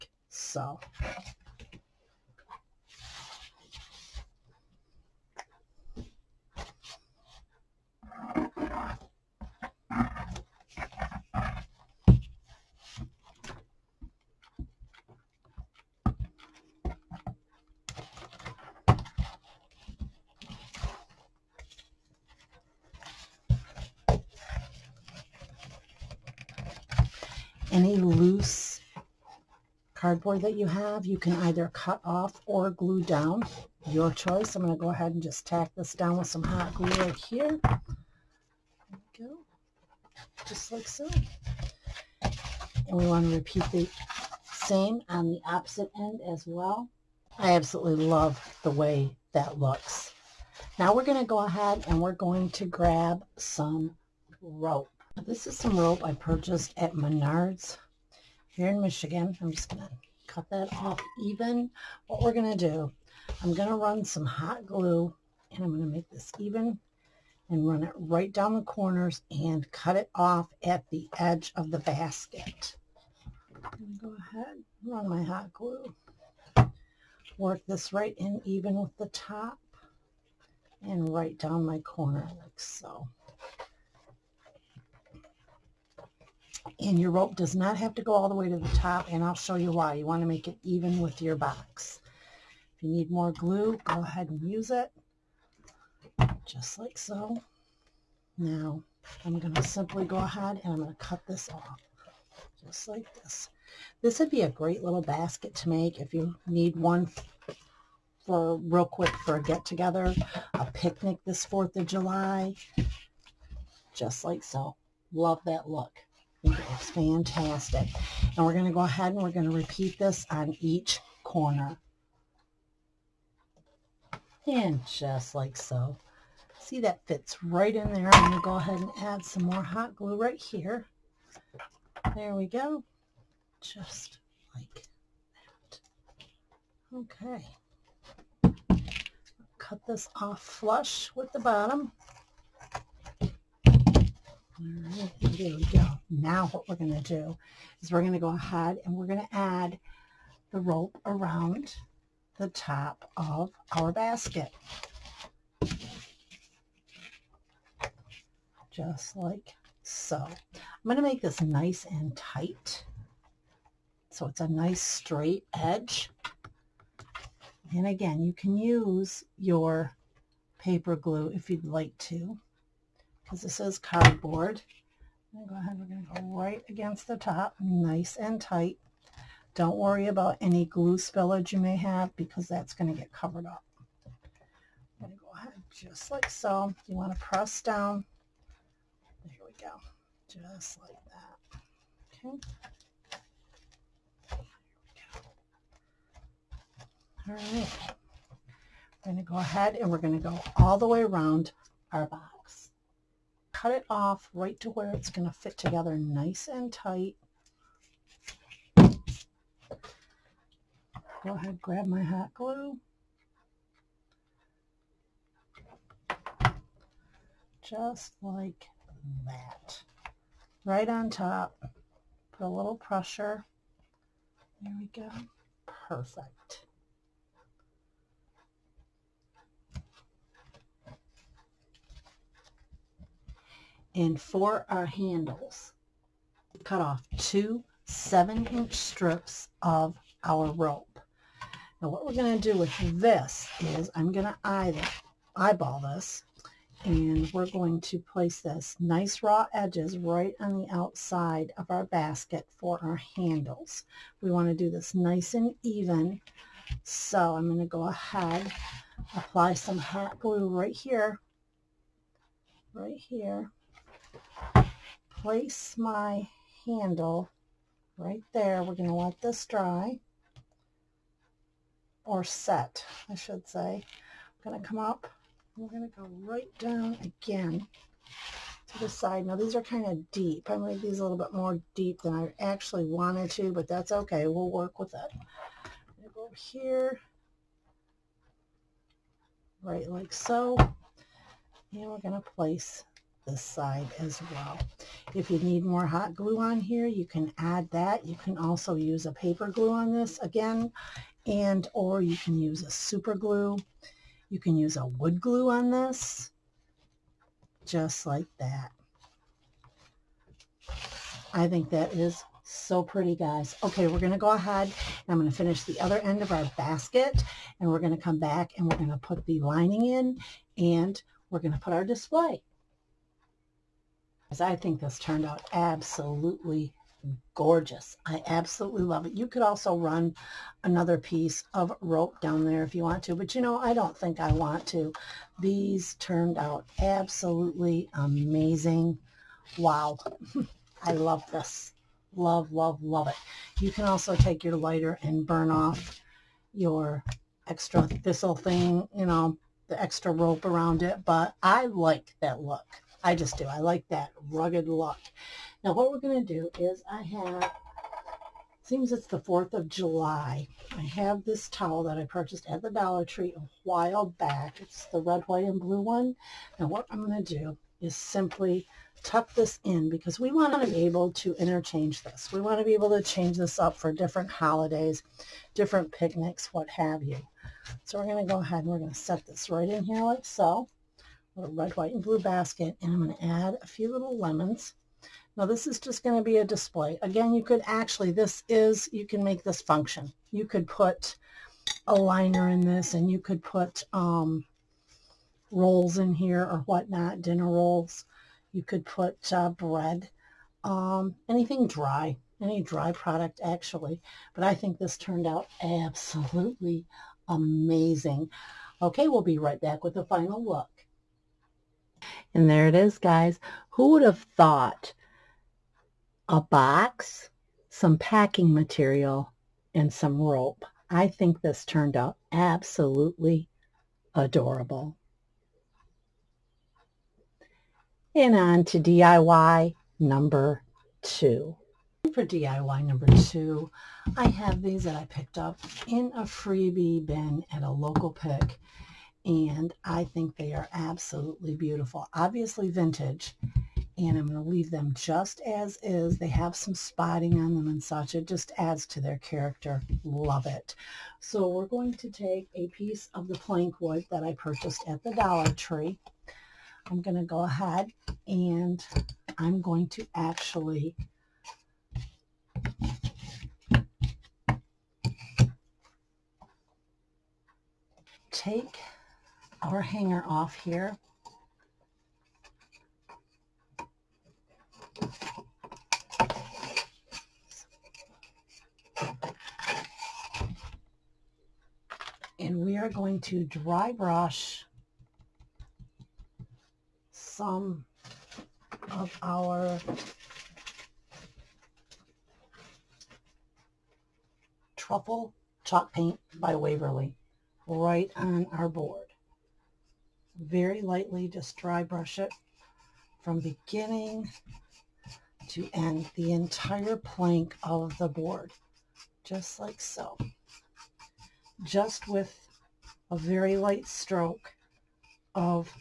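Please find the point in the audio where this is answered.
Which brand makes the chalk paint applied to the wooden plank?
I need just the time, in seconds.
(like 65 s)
496 s.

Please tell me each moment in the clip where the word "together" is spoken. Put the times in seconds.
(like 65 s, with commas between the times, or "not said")
109 s, 205 s.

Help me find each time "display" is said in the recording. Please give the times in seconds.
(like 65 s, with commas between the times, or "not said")
321 s, 386 s.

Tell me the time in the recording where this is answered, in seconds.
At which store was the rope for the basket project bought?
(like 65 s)
56 s.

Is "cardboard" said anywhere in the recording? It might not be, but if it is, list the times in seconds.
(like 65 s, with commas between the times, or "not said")
30 s, 173 s.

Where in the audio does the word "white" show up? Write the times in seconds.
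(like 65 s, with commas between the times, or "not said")
365 s, 381 s.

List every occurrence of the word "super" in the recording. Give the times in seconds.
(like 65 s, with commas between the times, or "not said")
302 s.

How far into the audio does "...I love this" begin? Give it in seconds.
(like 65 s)
340 s.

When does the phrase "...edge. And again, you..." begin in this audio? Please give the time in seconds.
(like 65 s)
165 s.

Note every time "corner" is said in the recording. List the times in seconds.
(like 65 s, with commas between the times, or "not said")
68 s, 81 s, 121 s.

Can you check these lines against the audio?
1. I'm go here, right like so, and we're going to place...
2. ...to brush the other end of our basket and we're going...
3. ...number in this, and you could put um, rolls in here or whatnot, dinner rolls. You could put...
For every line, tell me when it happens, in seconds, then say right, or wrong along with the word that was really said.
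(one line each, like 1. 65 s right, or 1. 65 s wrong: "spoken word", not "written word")
1. 285 s right
2. 315 s wrong: "finish", not "brush"
3. 391 s wrong: "liner", not "number".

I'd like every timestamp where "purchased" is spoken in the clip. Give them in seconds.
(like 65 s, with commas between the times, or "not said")
56 s, 362 s, 454 s.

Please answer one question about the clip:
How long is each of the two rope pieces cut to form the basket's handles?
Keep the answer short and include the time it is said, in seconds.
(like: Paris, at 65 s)
7 inches, at 237 s.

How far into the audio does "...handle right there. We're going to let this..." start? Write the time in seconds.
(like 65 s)
266 s.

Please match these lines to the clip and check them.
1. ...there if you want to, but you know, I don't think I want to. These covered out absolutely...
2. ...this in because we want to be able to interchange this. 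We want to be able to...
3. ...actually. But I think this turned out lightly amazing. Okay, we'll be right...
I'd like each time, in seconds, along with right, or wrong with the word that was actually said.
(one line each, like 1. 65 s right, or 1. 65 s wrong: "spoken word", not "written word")
1. 332 s wrong: "turned", not "covered"
2. 369 s right
3. 403 s wrong: "absolutely", not "lightly".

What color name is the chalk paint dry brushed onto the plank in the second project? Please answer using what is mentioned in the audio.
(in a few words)
truffle.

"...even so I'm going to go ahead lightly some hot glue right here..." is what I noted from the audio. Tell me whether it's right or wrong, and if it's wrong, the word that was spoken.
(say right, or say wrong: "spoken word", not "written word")
wrong: "apply", not "lightly".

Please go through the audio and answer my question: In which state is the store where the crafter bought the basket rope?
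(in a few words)
Michigan.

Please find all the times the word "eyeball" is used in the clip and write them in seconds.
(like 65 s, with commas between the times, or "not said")
245 s.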